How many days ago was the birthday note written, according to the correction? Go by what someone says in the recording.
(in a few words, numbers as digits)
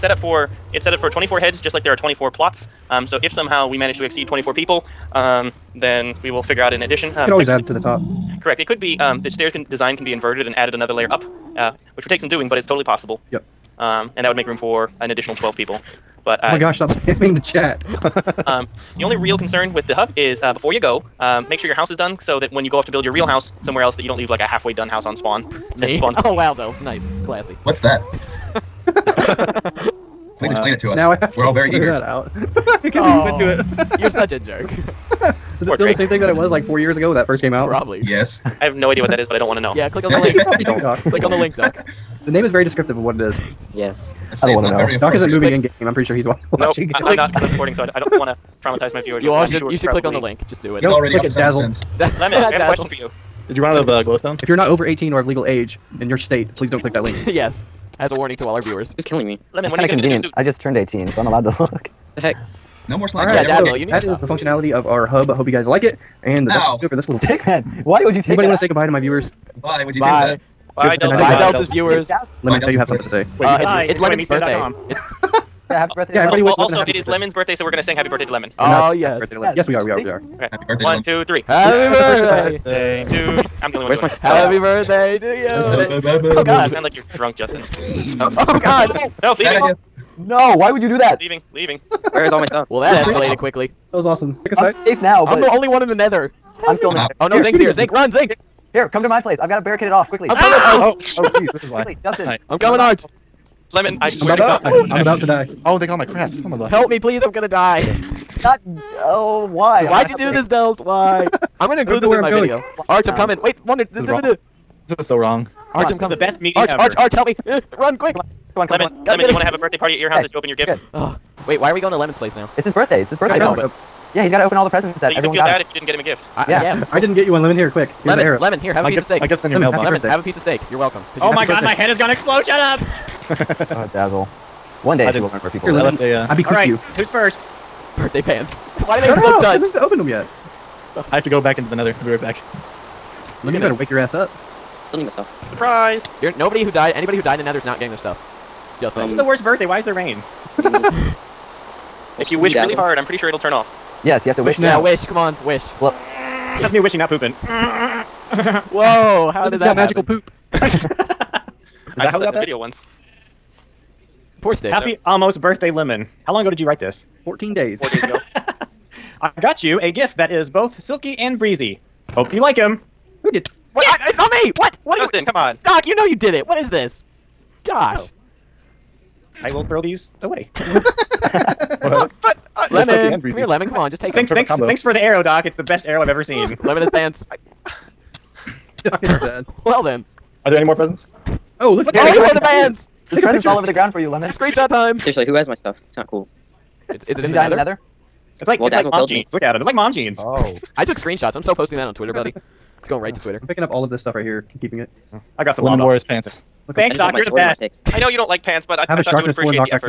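4.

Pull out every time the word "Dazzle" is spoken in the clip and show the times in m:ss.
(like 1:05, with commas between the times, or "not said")
0:51, 1:03, 2:13, 3:18.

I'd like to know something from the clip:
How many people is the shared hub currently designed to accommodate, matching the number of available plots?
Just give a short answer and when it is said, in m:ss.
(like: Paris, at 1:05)
24, at 0:01.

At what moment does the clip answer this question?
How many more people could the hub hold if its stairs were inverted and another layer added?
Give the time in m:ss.
0:15.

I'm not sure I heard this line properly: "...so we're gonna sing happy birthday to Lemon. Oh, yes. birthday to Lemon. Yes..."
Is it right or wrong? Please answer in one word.
right.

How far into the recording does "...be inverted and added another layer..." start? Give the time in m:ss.
0:10.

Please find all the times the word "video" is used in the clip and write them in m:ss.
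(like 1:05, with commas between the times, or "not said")
1:52, 2:42.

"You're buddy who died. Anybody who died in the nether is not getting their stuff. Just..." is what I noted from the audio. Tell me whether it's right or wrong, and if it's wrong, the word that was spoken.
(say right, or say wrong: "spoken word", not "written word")
wrong: "nobody", not "buddy".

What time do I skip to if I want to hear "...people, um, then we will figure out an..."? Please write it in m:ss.
0:04.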